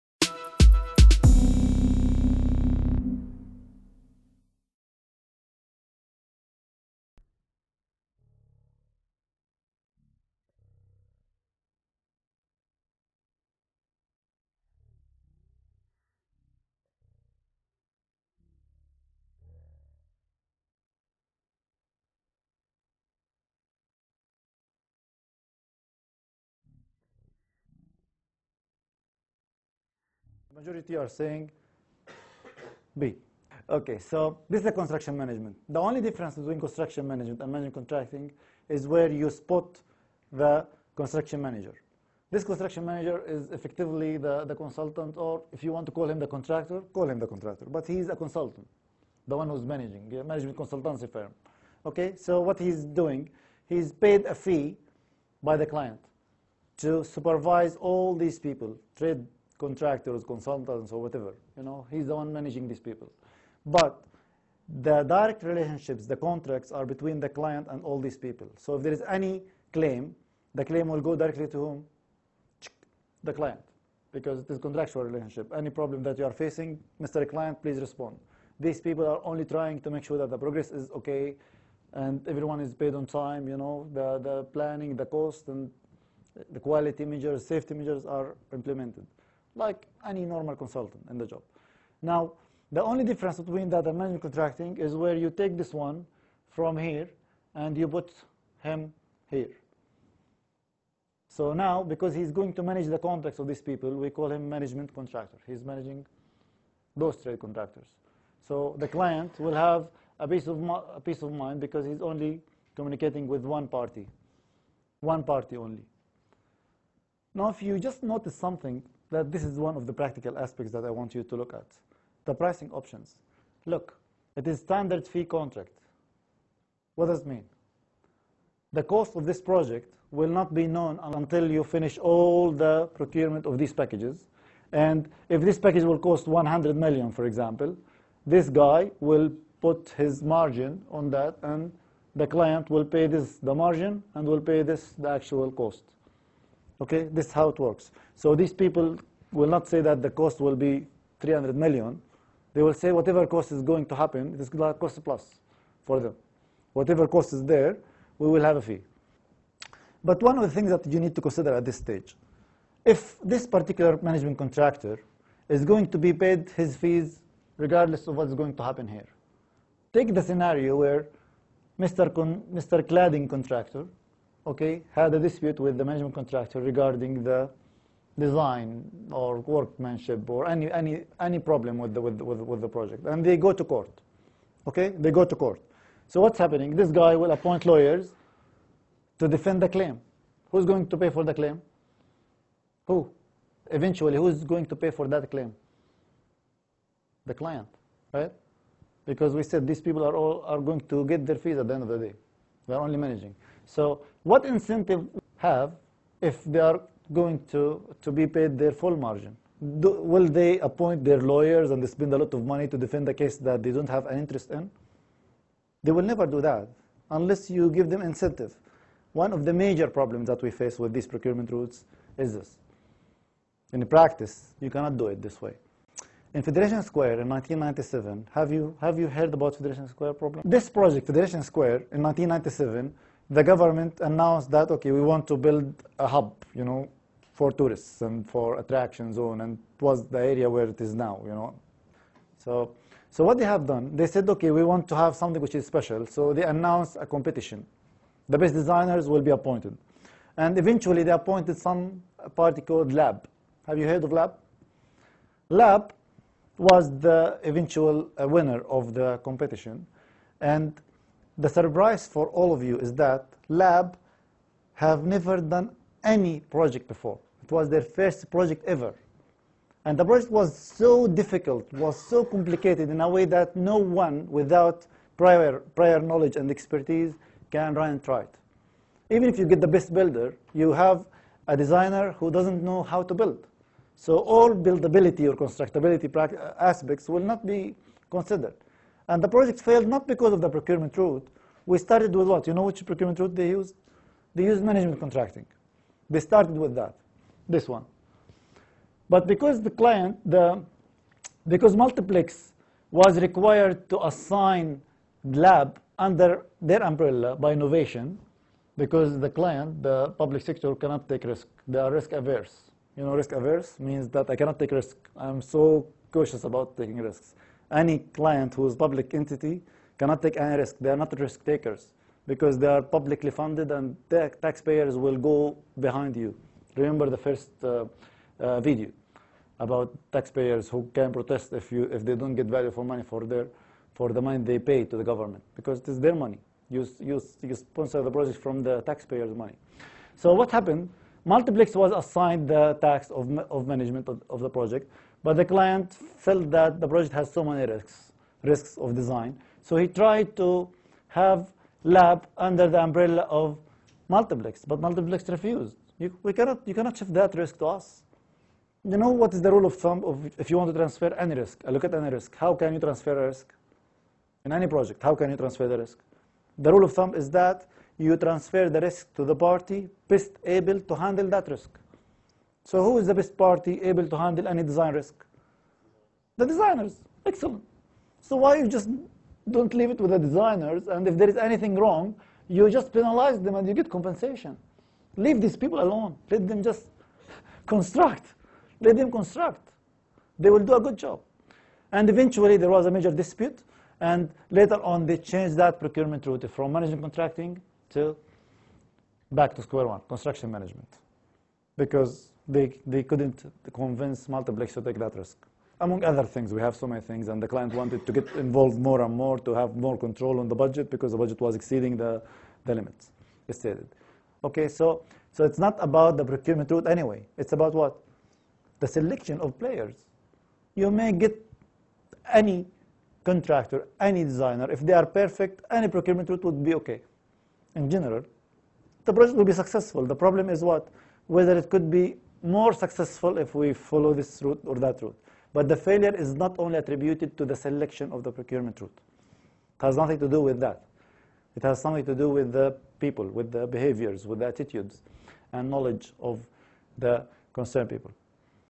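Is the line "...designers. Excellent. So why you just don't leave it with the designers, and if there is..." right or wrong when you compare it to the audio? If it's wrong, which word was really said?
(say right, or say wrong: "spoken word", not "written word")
right.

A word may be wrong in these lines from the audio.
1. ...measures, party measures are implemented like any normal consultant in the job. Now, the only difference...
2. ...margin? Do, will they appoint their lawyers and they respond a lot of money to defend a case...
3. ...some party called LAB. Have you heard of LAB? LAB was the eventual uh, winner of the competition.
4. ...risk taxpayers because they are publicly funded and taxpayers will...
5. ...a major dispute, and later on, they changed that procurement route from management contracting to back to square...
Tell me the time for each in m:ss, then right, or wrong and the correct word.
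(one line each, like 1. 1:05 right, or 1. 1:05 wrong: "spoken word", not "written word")
1. 1:27 wrong: "safety", not "party"
2. 3:28 wrong: "spend", not "respond"
3. 4:11 right
4. 5:21 wrong: "takers", not "taxpayers"
5. 6:32 right.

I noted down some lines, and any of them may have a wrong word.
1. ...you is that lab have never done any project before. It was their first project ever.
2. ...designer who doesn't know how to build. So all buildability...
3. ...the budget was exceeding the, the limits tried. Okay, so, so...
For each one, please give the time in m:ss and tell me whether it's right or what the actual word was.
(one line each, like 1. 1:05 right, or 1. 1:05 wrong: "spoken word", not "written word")
1. 4:22 right
2. 4:41 right
3. 6:51 wrong: "stated", not "tried".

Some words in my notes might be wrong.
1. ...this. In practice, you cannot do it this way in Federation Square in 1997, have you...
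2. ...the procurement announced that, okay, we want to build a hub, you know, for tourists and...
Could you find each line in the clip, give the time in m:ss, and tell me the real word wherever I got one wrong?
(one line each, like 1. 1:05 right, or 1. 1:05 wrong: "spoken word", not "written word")
1. 3:42 right
2. 3:53 wrong: "government", not "procurement".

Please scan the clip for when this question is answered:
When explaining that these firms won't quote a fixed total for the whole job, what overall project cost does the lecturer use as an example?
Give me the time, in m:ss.
2:31.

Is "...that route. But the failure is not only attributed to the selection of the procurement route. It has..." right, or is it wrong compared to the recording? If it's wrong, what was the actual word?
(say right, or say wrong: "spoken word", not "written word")
right.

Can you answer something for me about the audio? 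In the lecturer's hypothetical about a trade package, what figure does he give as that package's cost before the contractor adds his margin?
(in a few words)
100 million.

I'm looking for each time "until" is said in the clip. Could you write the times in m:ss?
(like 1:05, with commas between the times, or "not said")
2:11.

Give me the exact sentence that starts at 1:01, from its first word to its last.
You know, he's the one managing these people.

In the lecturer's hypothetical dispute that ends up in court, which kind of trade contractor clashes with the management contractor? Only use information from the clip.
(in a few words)
Cladding contractor.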